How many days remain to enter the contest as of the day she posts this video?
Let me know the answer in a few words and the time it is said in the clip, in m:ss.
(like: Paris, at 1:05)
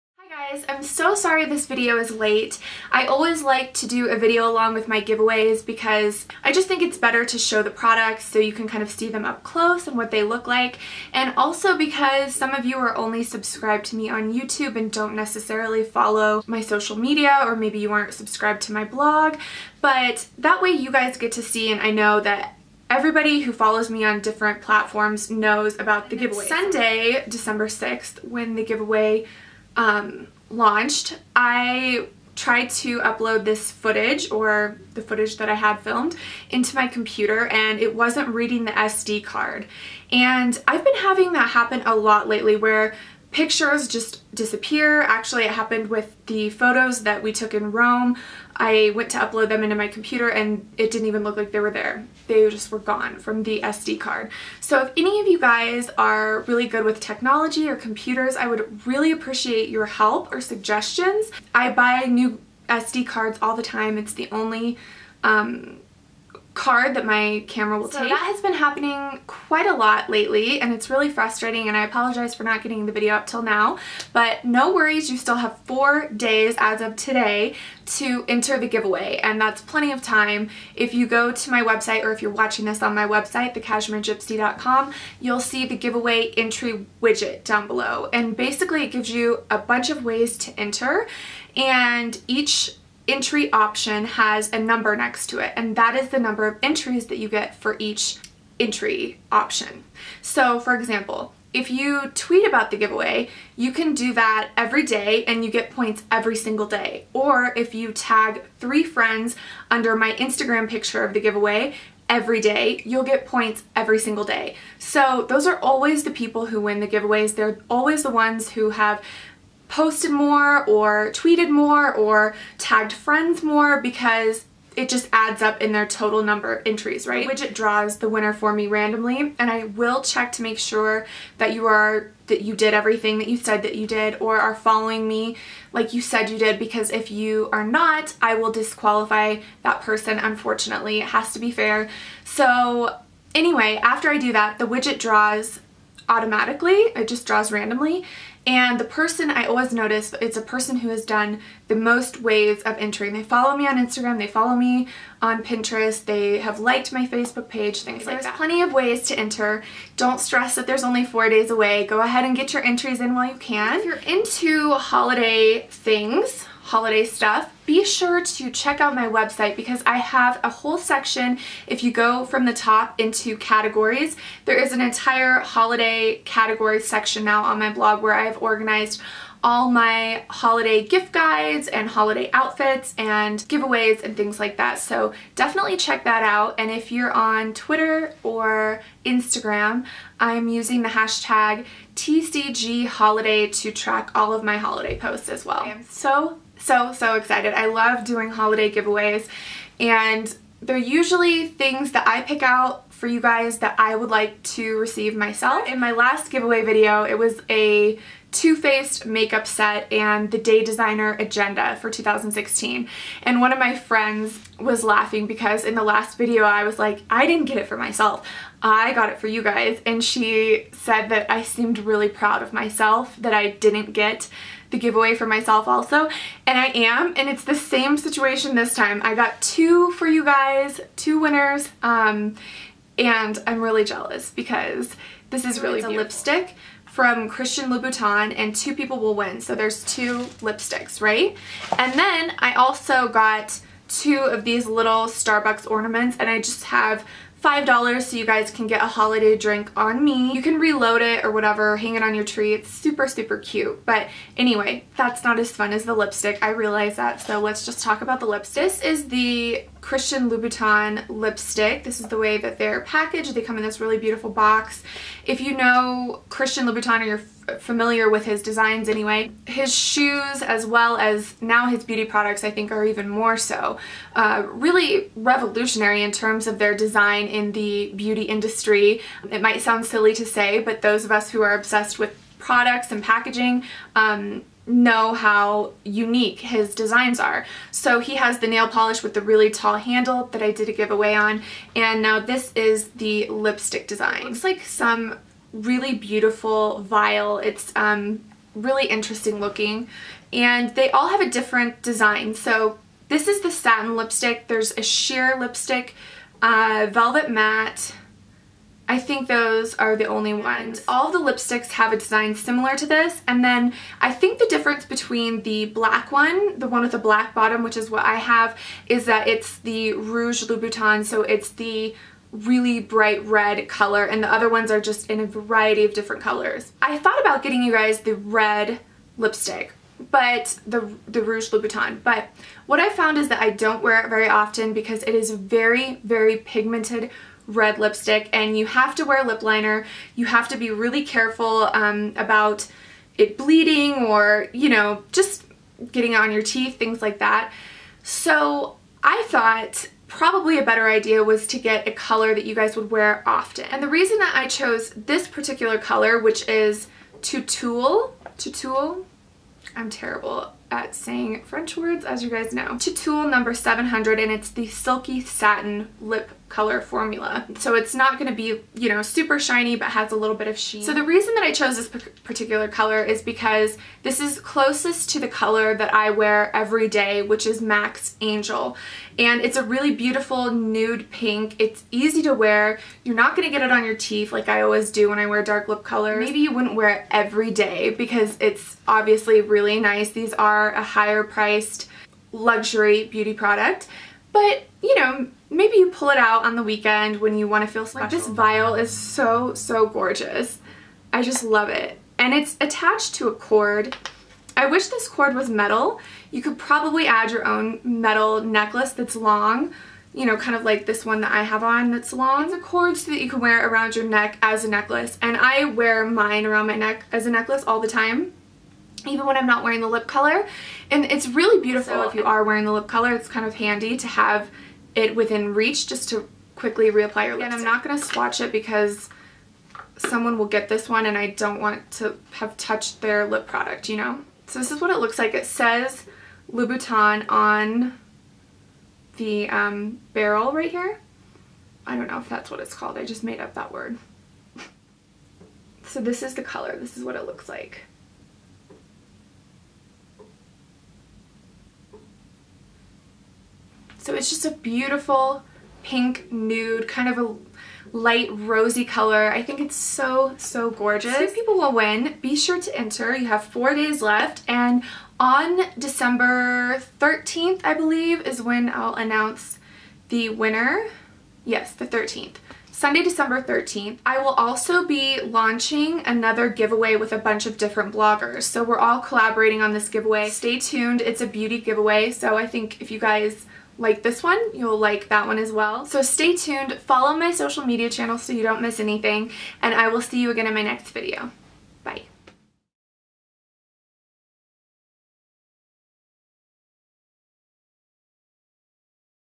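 4, at 1:15.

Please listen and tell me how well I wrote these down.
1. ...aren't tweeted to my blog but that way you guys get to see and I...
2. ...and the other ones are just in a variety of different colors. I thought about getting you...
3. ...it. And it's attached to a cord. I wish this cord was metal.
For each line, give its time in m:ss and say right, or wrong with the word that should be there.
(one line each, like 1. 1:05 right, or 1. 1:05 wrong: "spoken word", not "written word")
1. 0:17 wrong: "subscribed", not "tweeted"
2. 5:24 right
3. 6:41 right.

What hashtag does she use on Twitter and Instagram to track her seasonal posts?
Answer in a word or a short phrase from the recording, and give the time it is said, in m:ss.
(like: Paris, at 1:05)
TCG holiday, at 3:11.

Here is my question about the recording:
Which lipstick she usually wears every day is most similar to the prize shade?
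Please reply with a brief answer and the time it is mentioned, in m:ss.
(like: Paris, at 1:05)
Angel, at 6:18.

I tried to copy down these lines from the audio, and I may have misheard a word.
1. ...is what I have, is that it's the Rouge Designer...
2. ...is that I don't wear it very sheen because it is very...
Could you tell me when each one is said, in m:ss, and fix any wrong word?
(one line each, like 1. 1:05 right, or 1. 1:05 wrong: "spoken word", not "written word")
1. 5:17 wrong: "Louboutin", not "Designer"
2. 5:33 wrong: "often", not "sheen".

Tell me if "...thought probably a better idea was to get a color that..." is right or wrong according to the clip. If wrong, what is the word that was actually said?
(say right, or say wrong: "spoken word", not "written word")
right.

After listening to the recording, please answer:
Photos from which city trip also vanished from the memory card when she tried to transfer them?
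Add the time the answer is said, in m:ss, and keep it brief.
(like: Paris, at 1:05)
Rome, at 0:47.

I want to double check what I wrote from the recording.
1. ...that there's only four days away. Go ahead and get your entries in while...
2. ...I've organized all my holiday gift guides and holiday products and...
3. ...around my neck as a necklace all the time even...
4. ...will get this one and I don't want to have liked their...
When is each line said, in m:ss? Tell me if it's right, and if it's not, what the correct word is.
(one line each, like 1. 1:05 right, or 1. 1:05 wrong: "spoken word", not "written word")
1. 2:40 right
2. 2:58 wrong: "outfits", not "products"
3. 6:56 right
4. 7:10 wrong: "touched", not "liked".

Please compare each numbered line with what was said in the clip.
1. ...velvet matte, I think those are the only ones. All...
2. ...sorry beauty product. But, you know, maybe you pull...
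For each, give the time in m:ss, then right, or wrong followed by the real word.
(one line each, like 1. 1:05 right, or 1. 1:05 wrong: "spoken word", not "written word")
1. 5:06 right
2. 6:32 wrong: "luxury", not "sorry".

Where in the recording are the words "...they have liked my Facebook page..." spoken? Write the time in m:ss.
2:36.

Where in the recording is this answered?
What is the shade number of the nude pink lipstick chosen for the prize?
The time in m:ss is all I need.
6:03.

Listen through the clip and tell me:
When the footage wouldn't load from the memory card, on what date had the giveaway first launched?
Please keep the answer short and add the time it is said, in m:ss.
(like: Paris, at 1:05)
Sunday, December 6th, at 0:26.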